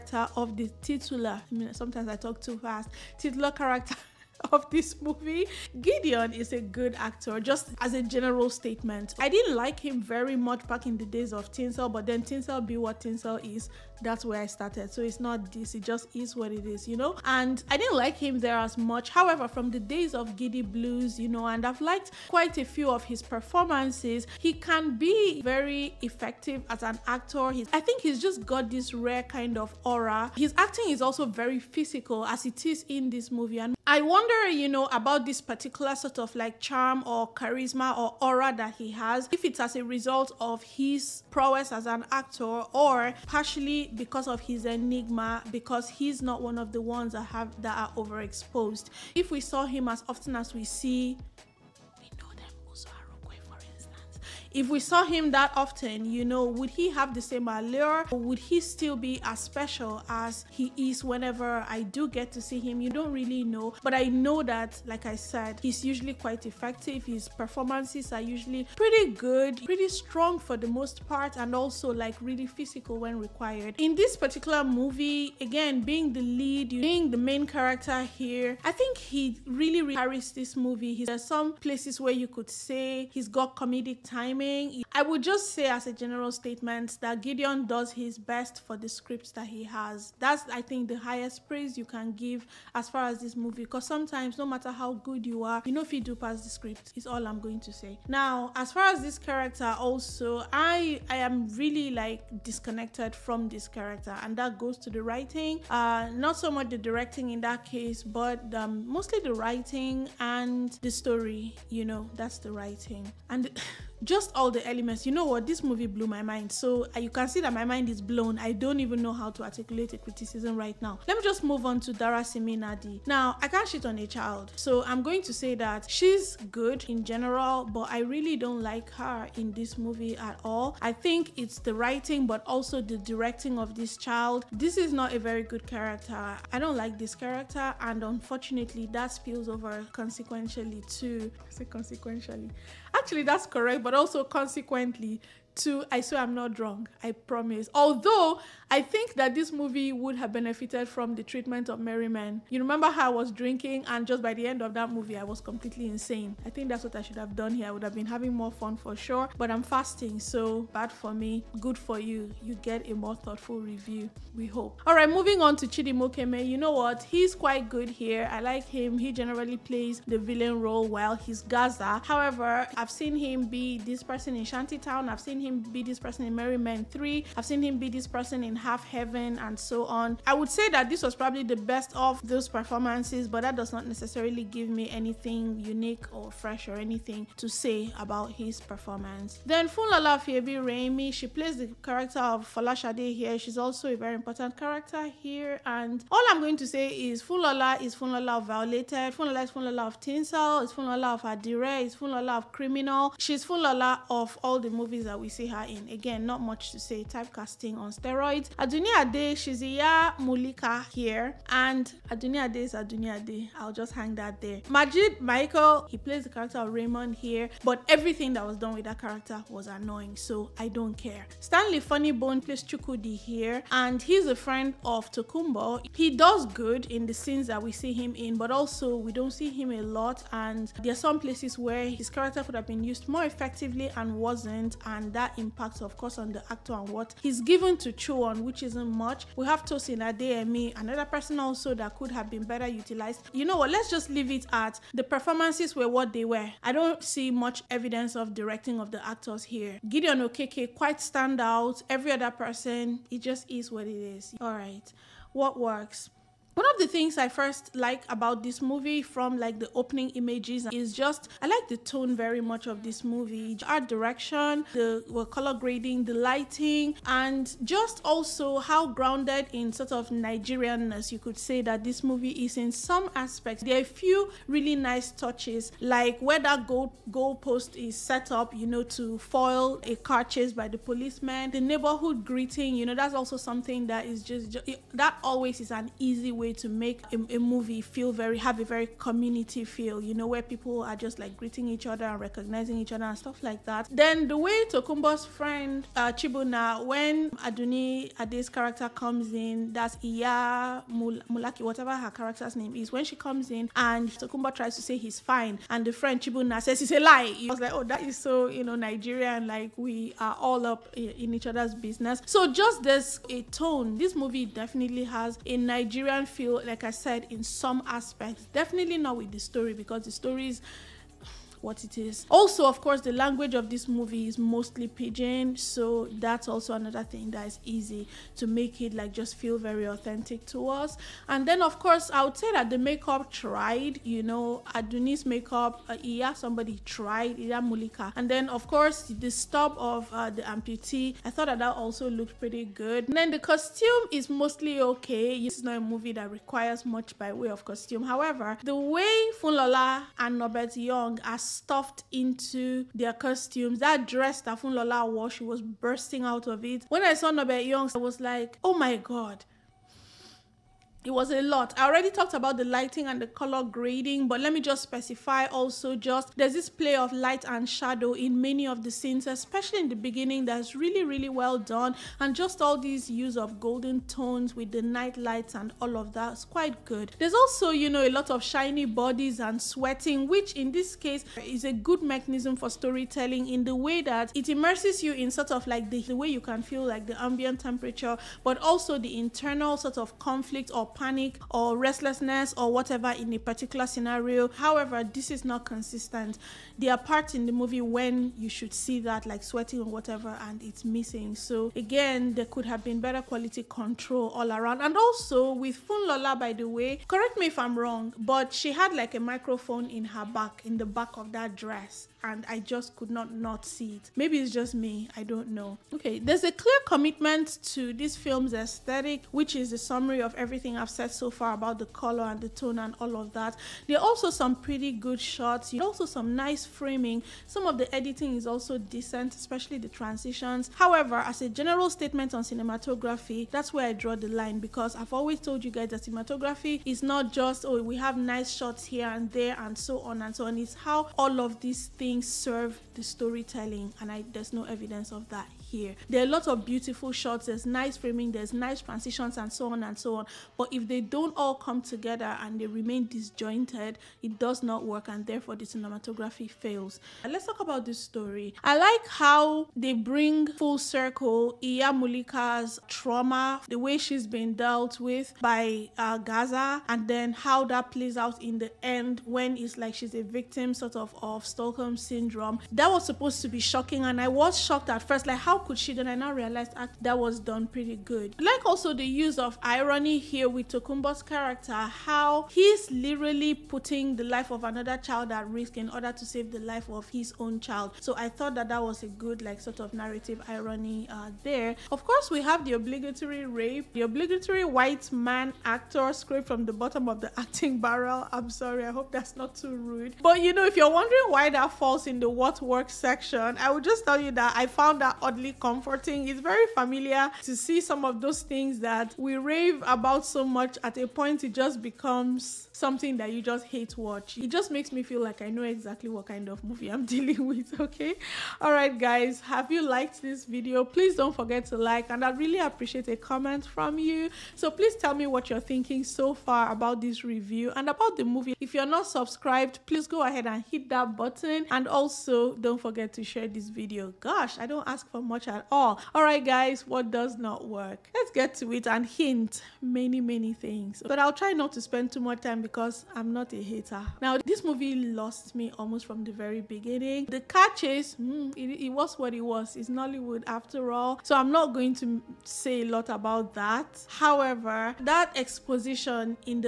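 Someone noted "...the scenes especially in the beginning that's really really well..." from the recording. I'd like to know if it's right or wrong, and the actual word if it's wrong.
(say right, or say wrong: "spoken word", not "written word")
right.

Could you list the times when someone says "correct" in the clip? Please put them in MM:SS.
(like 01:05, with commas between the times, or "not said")
02:23, 06:47.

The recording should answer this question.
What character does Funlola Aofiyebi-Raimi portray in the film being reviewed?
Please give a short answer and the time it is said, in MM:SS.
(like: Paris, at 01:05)
Folashade, at 03:11.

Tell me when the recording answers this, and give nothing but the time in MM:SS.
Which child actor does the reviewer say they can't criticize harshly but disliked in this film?
02:01.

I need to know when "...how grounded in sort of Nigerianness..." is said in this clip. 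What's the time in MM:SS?
04:28.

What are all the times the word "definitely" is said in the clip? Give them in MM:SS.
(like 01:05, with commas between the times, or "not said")
05:14, 05:18.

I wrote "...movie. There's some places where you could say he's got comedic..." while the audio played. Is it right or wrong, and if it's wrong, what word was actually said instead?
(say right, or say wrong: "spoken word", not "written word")
right.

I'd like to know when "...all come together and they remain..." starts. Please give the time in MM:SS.
07:31.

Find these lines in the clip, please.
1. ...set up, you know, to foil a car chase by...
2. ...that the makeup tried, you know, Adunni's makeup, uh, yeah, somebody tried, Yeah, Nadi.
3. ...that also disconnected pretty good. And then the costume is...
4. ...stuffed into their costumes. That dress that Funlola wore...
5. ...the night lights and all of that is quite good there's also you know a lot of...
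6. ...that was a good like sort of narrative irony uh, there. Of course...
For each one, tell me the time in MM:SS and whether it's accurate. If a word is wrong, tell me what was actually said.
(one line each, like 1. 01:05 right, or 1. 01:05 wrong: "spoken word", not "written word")
1. 04:37 right
2. 05:32 wrong: "Mulika", not "Nadi"
3. 05:41 wrong: "looked", not "disconnected"
4. 05:51 right
5. 06:14 right
6. 08:08 right.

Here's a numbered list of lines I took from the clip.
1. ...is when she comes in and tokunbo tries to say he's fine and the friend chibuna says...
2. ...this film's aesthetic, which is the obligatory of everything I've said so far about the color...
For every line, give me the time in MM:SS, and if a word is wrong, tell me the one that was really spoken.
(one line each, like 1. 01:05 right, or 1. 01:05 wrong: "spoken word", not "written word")
1. 05:02 right
2. 06:57 wrong: "summary", not "obligatory".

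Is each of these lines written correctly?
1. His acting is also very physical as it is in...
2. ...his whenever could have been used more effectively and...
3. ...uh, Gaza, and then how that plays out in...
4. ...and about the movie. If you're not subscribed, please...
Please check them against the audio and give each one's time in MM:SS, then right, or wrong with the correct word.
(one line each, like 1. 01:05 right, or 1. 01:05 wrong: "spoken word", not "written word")
1. 00:30 right
2. 03:51 wrong: "character", not "whenever"
3. 07:45 right
4. 08:47 right.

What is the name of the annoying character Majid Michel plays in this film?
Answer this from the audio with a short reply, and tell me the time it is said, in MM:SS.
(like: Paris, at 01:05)
Raymond, at 03:36.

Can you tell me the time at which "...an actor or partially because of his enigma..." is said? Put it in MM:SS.
00:41.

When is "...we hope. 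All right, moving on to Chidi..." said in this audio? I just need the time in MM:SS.
02:44.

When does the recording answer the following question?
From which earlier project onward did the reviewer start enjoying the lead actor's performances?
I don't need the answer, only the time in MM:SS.
00:20.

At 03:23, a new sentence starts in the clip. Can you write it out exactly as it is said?
She's Funlola of all the movies that we see her in.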